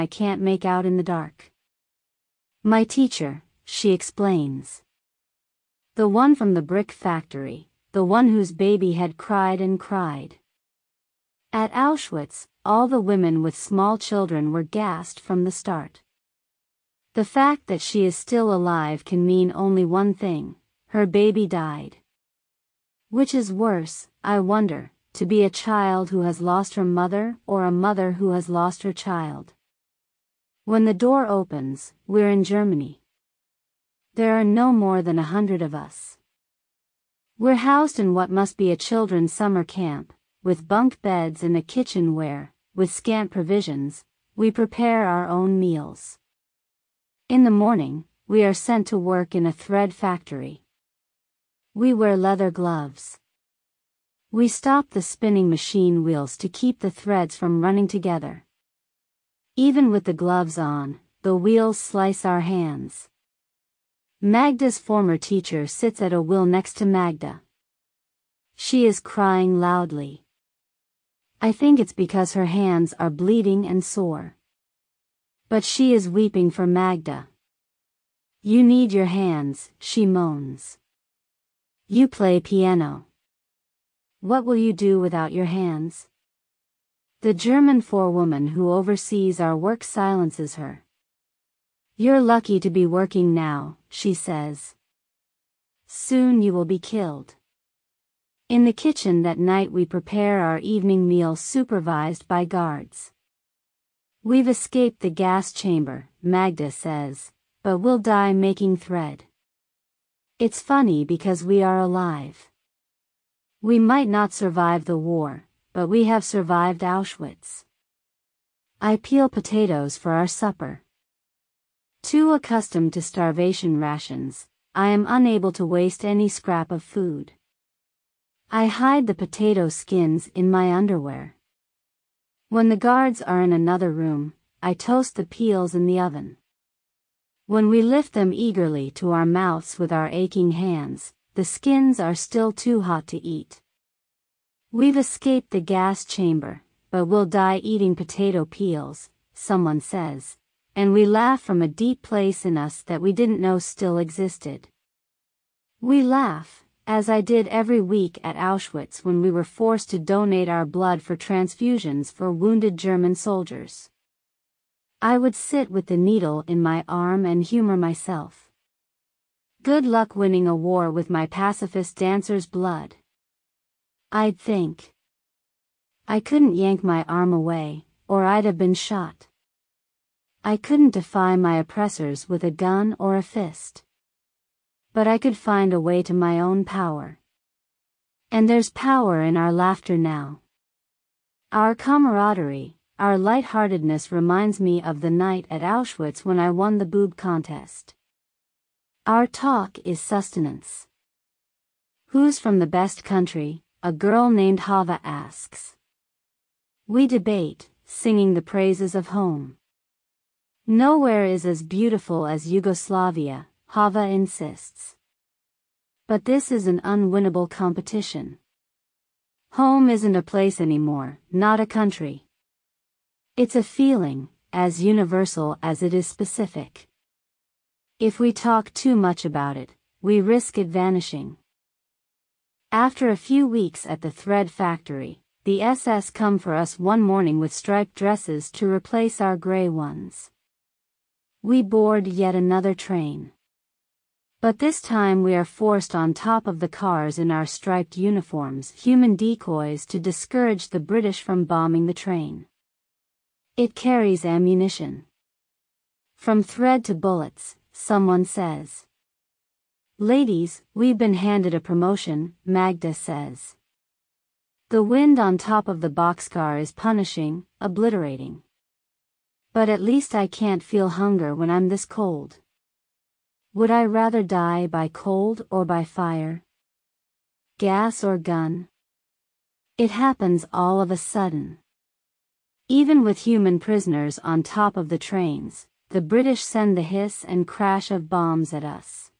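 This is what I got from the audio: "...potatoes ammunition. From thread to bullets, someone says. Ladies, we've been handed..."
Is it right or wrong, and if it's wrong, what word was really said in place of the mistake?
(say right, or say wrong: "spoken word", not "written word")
wrong: "carries", not "potatoes".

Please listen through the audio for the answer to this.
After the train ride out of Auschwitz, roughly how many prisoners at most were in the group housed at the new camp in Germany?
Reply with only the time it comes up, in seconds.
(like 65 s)
35 s.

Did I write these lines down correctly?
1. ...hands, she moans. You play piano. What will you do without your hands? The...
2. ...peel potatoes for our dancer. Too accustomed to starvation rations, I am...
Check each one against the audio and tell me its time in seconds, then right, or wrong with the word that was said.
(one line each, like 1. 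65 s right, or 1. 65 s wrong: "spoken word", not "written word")
1. 79 s right
2. 118 s wrong: "supper", not "dancer".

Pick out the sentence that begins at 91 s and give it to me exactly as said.
You're lucky to be working now, she says.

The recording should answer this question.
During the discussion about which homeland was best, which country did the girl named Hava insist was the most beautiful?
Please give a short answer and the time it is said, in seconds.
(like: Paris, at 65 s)
Yugoslavia, at 212 s.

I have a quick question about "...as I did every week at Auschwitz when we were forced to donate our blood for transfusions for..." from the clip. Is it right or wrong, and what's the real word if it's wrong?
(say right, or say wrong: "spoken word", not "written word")
right.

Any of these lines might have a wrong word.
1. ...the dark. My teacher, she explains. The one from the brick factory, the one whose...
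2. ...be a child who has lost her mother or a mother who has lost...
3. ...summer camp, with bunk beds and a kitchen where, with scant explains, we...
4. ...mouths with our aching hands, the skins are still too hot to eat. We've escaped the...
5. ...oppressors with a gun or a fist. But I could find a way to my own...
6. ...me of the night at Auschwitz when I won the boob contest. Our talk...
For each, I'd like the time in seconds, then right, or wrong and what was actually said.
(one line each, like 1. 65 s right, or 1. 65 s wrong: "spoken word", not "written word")
1. 0 s right
2. 25 s right
3. 39 s wrong: "provisions", not "explains"
4. 139 s right
5. 181 s right
6. 194 s right.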